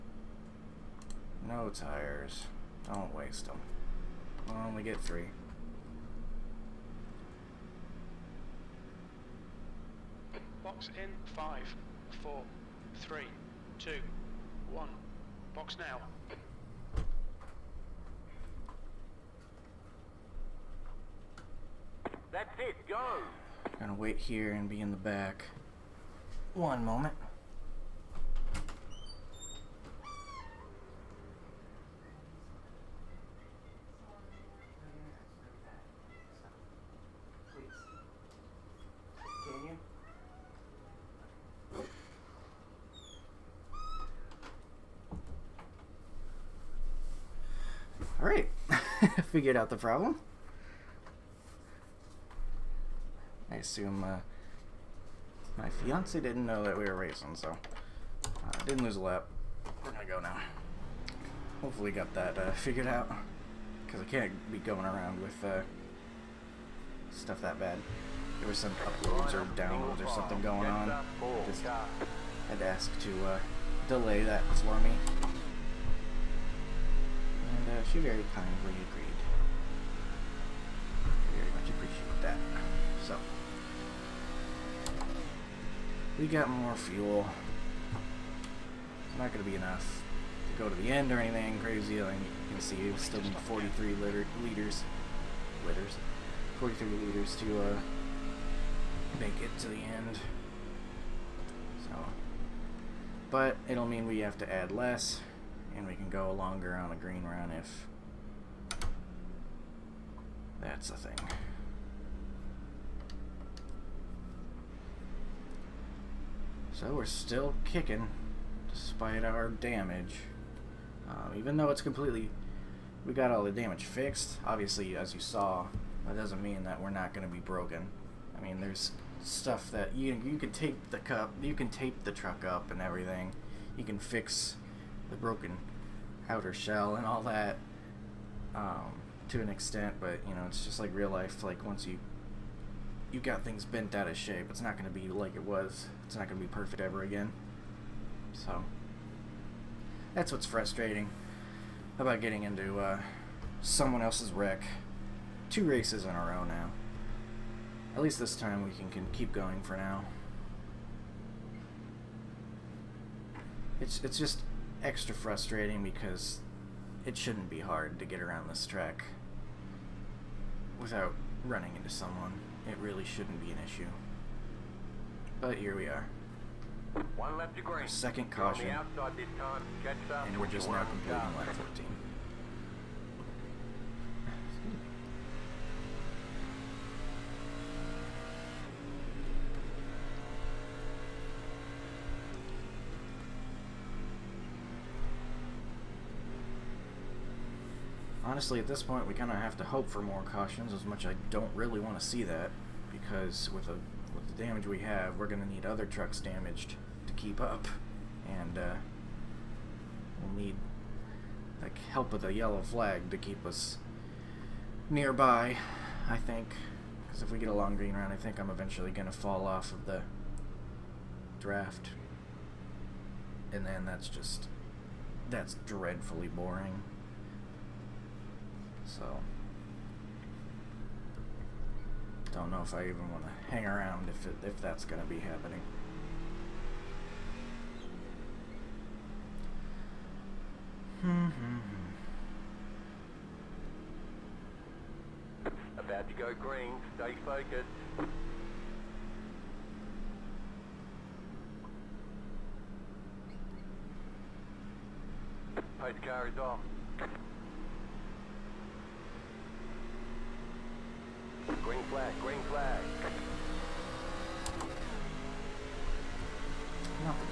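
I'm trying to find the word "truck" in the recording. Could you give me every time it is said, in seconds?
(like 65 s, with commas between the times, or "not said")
132 s, 205 s.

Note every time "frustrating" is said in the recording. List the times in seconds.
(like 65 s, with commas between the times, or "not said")
150 s, 165 s.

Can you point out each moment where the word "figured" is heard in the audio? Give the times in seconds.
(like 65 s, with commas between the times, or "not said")
49 s, 62 s.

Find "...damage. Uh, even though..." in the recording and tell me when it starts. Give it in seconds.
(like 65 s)
119 s.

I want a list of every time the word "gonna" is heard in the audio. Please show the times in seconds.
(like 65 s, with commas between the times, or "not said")
23 s, 59 s.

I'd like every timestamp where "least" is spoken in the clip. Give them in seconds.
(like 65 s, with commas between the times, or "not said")
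158 s.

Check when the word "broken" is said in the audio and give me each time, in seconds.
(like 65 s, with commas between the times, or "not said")
127 s, 135 s.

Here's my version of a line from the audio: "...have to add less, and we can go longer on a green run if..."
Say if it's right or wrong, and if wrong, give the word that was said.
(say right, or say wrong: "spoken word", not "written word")
right.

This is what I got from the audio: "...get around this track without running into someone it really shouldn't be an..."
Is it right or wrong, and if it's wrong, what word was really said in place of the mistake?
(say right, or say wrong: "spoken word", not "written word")
right.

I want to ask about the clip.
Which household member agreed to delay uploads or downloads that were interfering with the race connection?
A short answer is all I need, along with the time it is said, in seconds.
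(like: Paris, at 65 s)
fiance, at 55 s.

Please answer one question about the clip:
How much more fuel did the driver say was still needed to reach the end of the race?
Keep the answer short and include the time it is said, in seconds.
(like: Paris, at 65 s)
43 liters, at 96 s.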